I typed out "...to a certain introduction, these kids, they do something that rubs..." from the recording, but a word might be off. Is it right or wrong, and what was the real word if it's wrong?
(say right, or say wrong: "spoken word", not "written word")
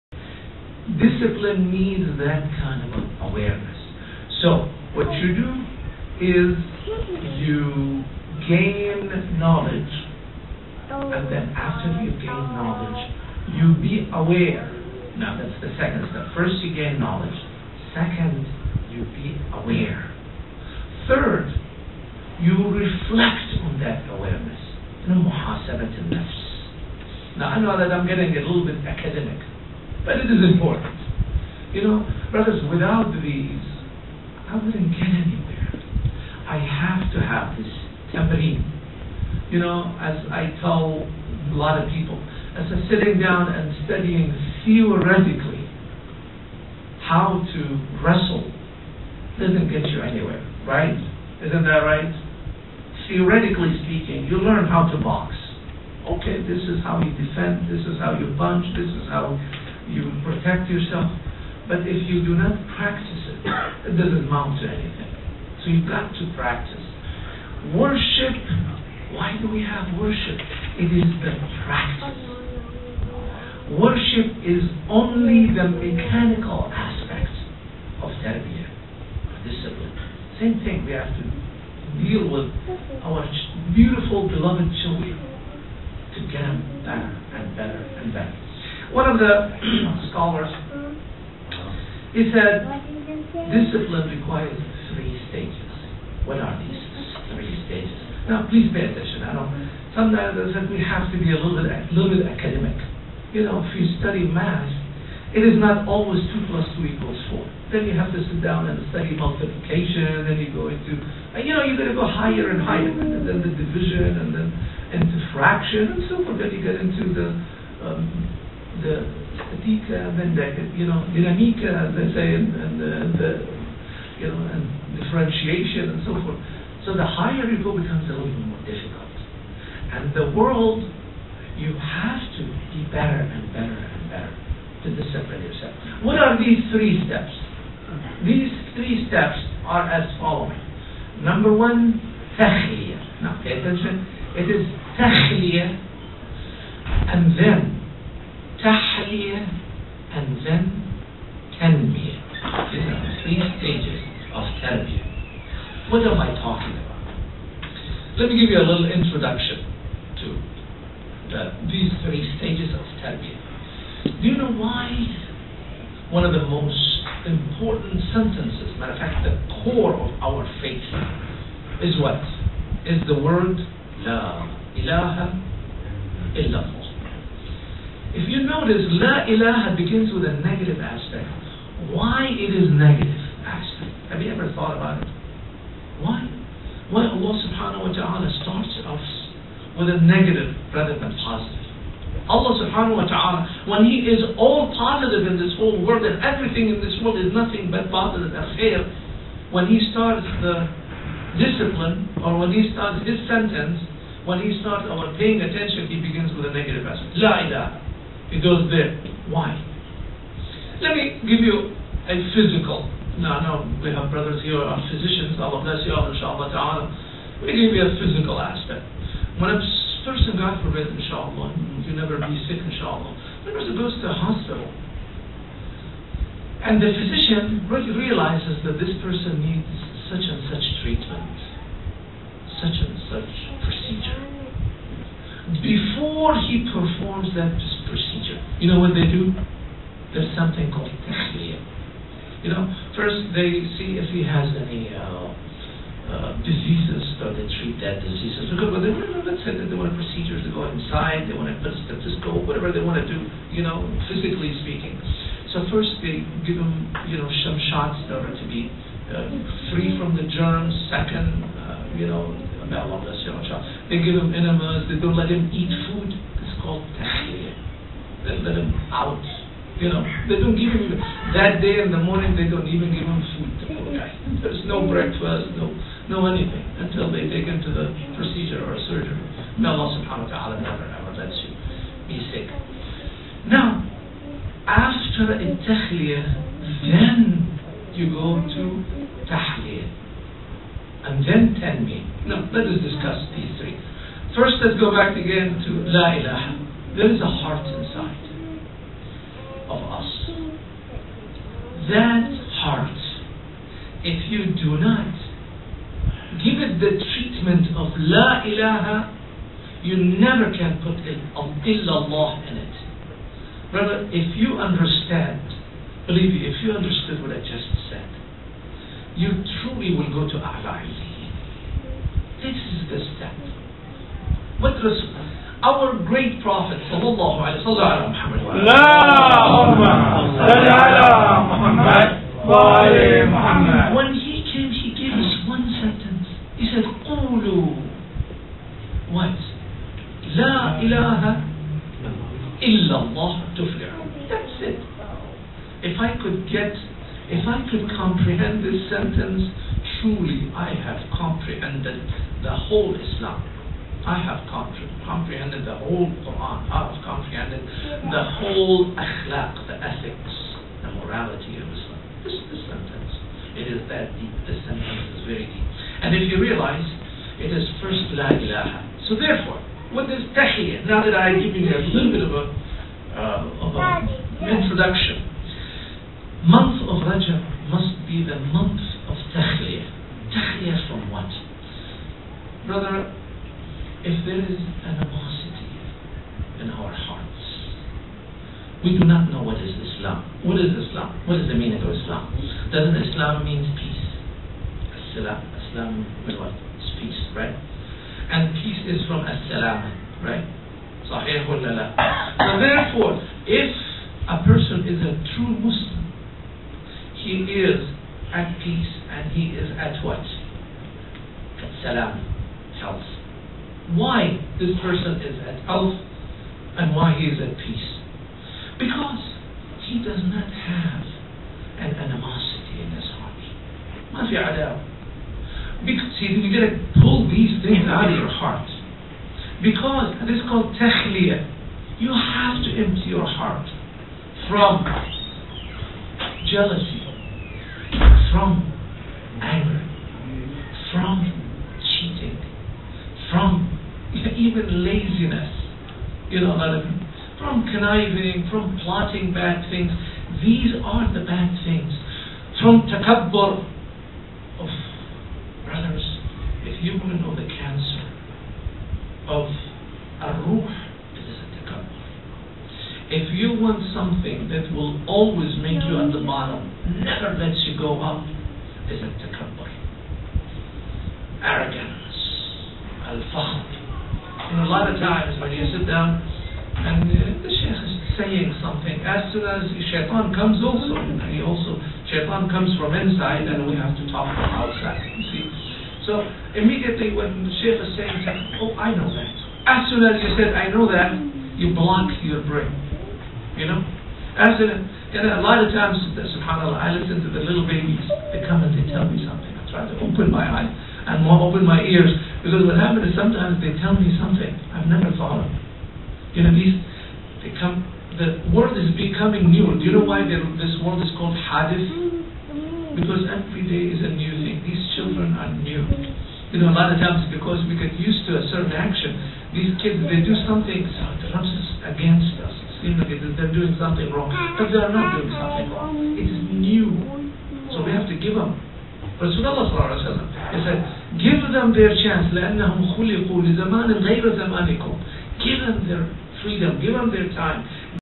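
wrong: "action", not "introduction".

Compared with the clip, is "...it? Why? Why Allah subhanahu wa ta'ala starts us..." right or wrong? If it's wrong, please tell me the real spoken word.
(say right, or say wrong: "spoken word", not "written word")
right.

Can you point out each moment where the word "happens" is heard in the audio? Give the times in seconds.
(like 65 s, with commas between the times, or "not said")
502 s.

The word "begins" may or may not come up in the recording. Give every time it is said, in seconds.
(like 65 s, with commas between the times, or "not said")
179 s, 206 s.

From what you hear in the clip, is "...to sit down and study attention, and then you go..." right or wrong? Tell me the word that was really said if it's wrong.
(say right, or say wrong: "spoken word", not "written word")
wrong: "multiplication", not "attention".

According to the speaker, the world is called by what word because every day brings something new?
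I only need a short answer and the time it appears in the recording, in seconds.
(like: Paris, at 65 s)
Hadith, at 511 s.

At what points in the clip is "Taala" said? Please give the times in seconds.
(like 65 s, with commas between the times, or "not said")
280 s.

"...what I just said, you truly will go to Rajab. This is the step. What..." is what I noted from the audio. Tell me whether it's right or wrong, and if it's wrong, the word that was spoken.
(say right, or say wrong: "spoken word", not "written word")
wrong: "Allah", not "Rajab".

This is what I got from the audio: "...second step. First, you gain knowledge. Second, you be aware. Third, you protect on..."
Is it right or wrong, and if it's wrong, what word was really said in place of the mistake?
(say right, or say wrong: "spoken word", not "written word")
wrong: "reflect", not "protect".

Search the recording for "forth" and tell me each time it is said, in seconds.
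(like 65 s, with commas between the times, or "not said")
116 s, 126 s.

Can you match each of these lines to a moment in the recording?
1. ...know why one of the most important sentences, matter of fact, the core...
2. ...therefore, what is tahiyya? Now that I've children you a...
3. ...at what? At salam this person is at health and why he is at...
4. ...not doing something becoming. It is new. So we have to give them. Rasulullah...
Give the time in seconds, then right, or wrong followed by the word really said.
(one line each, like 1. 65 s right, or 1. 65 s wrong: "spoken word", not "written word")
1. 164 s right
2. 369 s wrong: "given", not "children"
3. 409 s right
4. 524 s wrong: "wrong", not "becoming".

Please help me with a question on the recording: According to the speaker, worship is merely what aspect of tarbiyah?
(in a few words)
The mechanical aspect.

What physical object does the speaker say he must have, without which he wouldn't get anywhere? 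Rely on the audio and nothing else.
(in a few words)
Tambourine.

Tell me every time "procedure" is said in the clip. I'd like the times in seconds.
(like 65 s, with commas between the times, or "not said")
233 s, 249 s, 278 s.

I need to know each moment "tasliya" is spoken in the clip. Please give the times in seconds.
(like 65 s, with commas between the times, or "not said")
241 s.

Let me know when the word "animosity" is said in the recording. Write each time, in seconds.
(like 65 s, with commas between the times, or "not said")
384 s, 421 s.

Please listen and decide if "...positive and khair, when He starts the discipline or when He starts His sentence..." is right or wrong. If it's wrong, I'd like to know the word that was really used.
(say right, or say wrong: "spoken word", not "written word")
right.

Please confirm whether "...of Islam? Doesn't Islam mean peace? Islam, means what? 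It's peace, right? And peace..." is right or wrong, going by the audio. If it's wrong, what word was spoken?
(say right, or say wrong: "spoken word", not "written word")
right.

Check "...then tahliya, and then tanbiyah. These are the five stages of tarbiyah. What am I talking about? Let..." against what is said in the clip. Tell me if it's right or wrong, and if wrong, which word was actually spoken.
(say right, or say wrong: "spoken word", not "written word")
wrong: "three", not "five".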